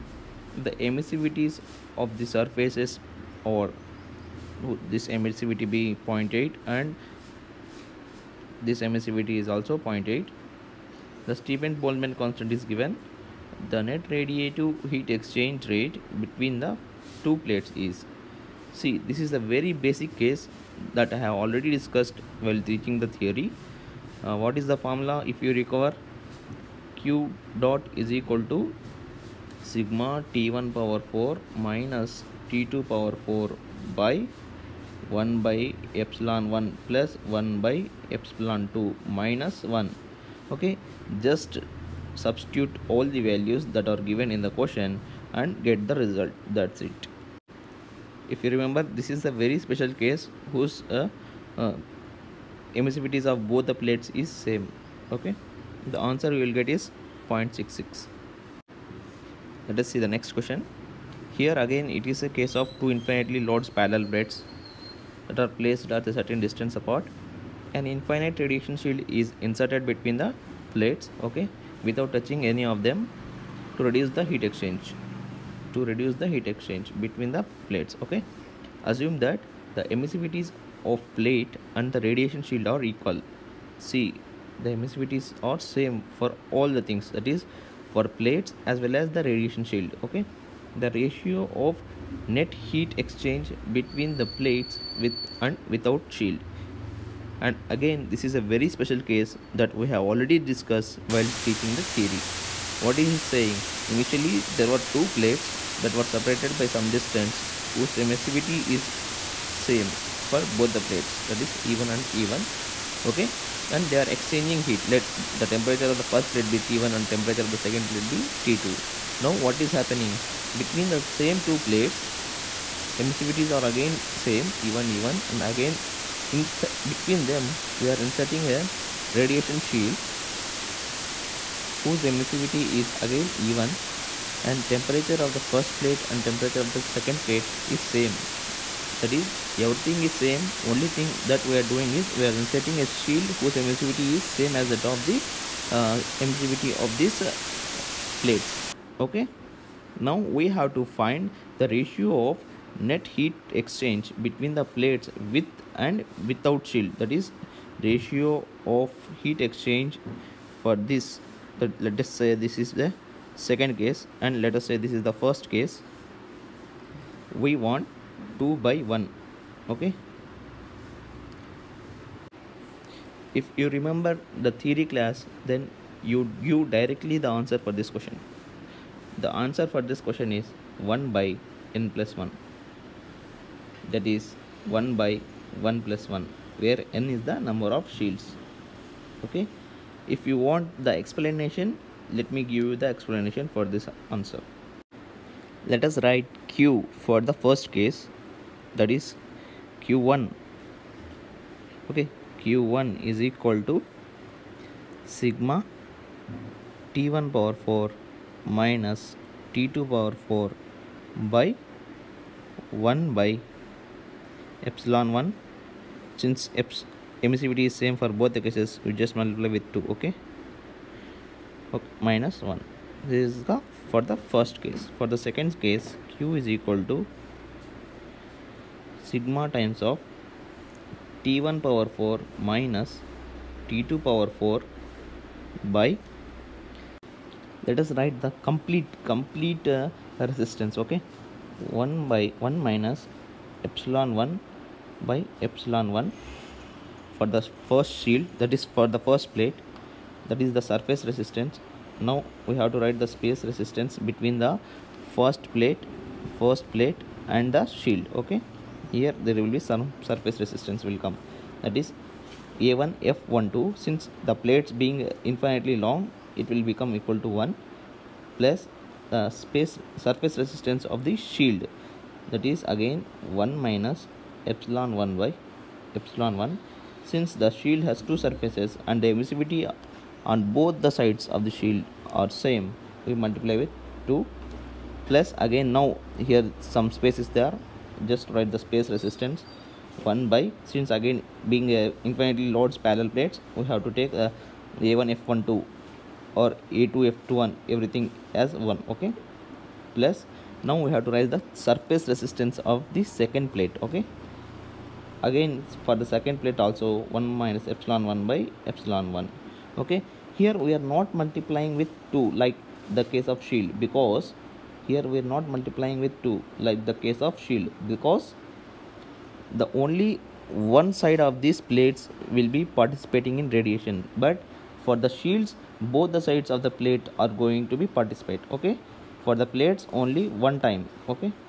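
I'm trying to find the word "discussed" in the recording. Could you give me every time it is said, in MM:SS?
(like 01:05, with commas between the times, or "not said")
00:21, 01:40.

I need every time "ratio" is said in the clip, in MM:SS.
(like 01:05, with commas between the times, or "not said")
01:30, 02:31, 02:37.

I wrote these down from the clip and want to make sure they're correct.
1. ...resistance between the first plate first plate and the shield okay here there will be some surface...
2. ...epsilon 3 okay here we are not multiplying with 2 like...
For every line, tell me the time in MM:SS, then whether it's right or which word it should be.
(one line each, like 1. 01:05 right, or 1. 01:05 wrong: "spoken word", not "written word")
1. 04:13 right
2. 05:08 wrong: "1", not "3".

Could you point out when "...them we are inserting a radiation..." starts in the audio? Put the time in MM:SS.
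02:07.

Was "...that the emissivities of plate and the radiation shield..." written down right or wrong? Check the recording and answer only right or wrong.
right.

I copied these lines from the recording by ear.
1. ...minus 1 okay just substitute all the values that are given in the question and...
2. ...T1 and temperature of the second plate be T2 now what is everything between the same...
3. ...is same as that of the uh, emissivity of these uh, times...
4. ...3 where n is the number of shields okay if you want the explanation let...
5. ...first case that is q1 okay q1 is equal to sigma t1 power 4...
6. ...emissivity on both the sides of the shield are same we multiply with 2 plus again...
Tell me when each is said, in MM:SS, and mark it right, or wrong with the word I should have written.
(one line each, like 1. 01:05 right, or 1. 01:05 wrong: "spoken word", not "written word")
1. 00:39 right
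2. 01:56 wrong: "happening", not "everything"
3. 02:24 wrong: "plates", not "times"
4. 03:06 wrong: "1", not "3"
5. 03:17 right
6. 04:39 right.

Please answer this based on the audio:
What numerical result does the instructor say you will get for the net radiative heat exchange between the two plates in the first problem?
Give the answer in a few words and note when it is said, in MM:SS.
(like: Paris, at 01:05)
0.66, at 00:57.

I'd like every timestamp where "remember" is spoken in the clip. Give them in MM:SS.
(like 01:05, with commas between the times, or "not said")
00:48, 02:53.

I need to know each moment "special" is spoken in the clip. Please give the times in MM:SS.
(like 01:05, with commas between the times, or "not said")
00:49, 01:38.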